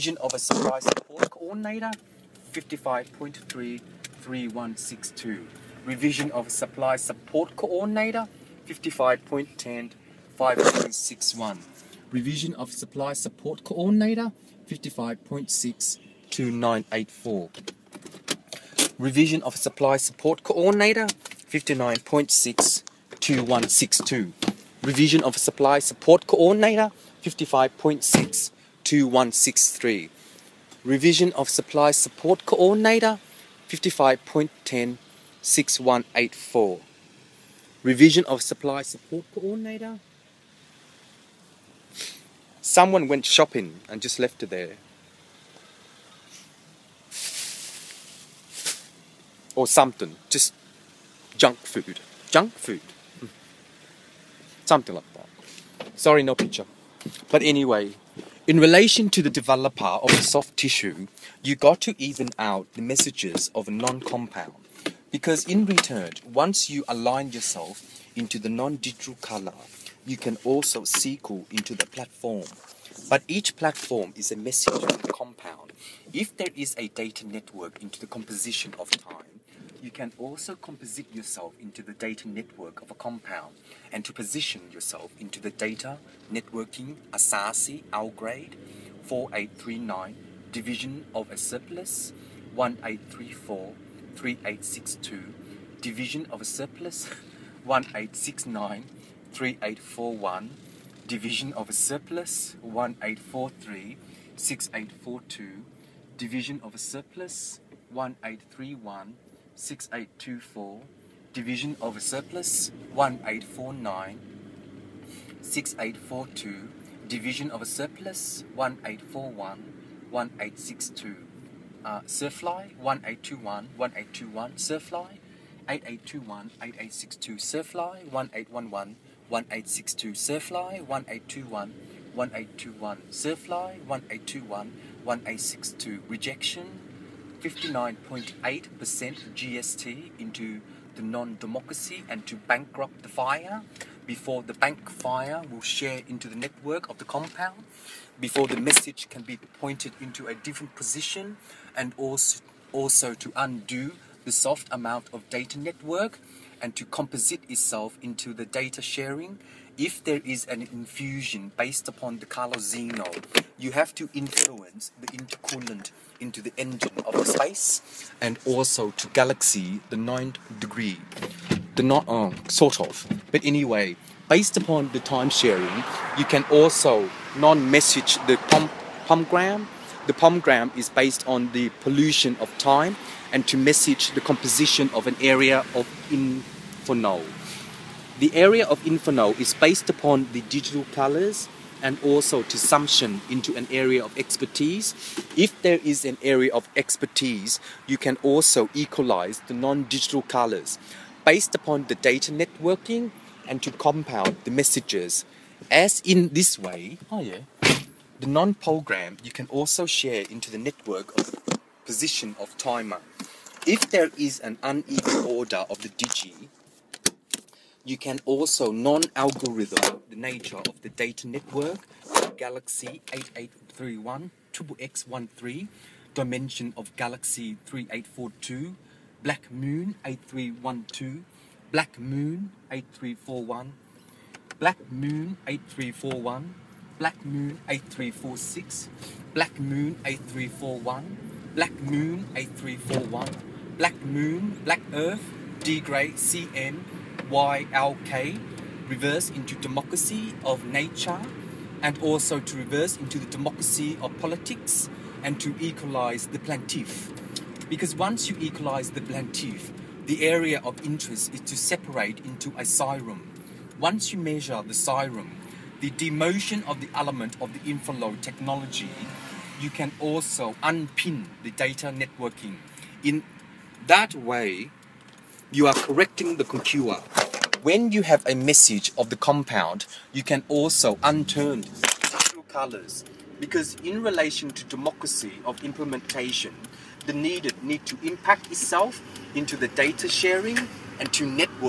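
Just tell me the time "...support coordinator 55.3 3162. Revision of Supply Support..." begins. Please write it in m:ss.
0:00.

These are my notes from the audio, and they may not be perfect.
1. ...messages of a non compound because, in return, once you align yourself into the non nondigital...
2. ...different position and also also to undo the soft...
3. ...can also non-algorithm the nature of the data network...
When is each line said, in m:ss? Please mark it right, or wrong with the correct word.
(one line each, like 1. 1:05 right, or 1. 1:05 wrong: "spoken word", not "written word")
1. 1:02 wrong: "digital", not "nondigital"
2. 2:30 right
3. 3:37 right.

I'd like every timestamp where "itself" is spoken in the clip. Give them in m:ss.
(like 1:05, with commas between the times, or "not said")
2:37, 4:48.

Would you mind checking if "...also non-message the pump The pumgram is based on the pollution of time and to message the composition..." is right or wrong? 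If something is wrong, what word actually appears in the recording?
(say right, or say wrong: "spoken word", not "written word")
right.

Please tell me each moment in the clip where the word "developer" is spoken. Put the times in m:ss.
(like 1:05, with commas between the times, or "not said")
0:59.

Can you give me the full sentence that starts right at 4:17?
Because once you equalize the plaintiff, the area of interest is to separate into a sirum.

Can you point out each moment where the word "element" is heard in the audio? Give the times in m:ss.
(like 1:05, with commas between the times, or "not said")
4:26.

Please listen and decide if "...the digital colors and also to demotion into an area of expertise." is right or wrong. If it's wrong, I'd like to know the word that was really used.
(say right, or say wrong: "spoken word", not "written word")
wrong: "sumption", not "demotion".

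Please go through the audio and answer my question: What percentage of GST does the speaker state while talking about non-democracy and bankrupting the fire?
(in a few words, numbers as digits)
59.8%.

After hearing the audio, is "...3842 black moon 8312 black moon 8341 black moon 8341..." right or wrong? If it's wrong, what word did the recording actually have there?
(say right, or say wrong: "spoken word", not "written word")
right.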